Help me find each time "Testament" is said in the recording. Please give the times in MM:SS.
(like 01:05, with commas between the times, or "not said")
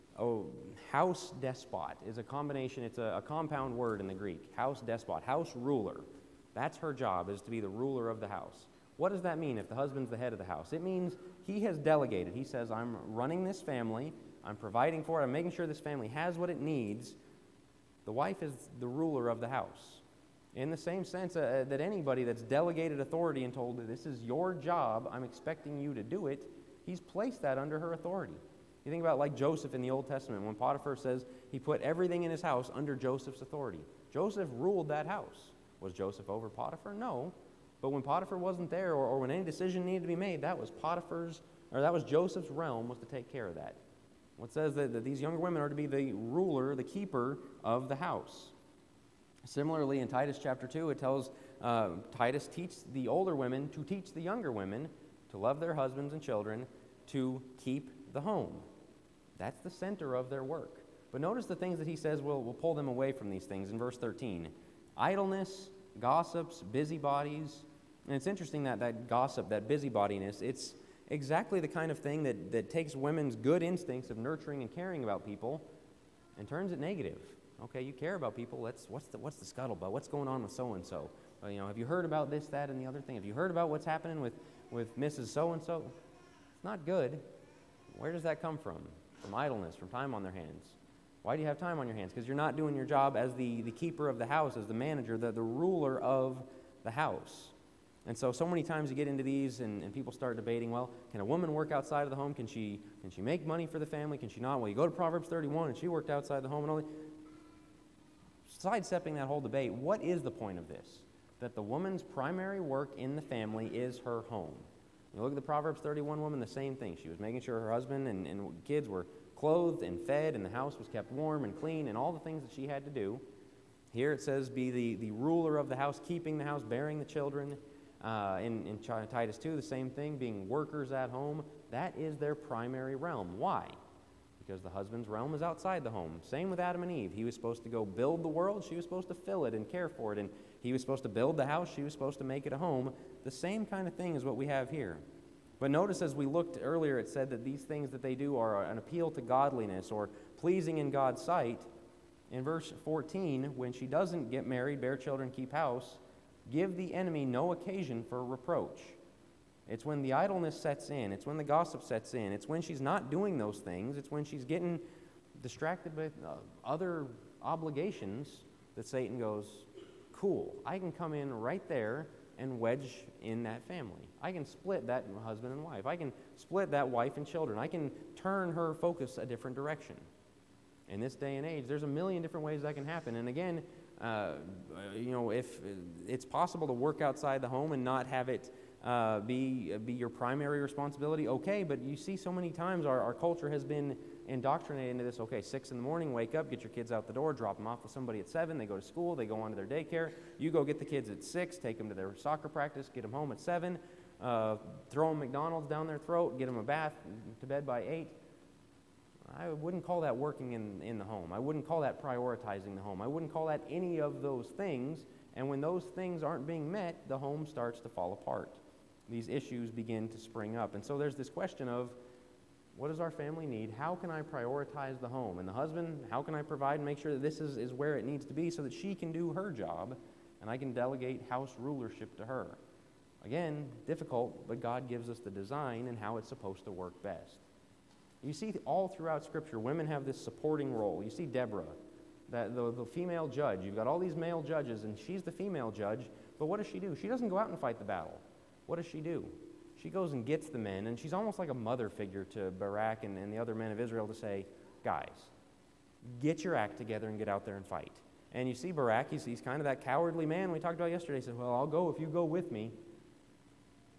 00:30.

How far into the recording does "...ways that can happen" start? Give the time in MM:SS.
03:02.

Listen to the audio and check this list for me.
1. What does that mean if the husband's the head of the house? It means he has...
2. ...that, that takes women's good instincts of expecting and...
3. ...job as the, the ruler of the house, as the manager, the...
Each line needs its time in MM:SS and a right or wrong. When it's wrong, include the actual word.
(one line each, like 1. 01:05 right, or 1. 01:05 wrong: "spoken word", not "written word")
1. 00:08 right
2. 01:12 wrong: "nurturing", not "expecting"
3. 01:32 wrong: "keeper", not "ruler".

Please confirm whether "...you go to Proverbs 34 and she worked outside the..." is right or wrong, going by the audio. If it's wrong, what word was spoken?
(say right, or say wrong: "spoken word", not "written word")
wrong: "31", not "34".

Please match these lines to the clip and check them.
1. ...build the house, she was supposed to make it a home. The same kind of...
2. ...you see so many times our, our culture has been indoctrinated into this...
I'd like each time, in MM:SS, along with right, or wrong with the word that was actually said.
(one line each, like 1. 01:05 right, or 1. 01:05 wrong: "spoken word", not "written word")
1. 02:21 right
2. 03:11 right.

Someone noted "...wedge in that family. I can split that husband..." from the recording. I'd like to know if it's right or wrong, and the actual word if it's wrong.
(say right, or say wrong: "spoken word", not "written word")
right.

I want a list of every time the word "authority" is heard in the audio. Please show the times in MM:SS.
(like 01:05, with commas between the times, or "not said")
00:23, 00:27, 00:33.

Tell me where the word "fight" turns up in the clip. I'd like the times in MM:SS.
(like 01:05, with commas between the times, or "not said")
04:07, 04:17.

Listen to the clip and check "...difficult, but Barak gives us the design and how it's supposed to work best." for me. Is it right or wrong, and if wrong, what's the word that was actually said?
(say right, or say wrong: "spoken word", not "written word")
wrong: "God", not "Barak".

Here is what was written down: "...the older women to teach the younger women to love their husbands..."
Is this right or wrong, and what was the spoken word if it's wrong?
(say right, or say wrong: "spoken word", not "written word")
right.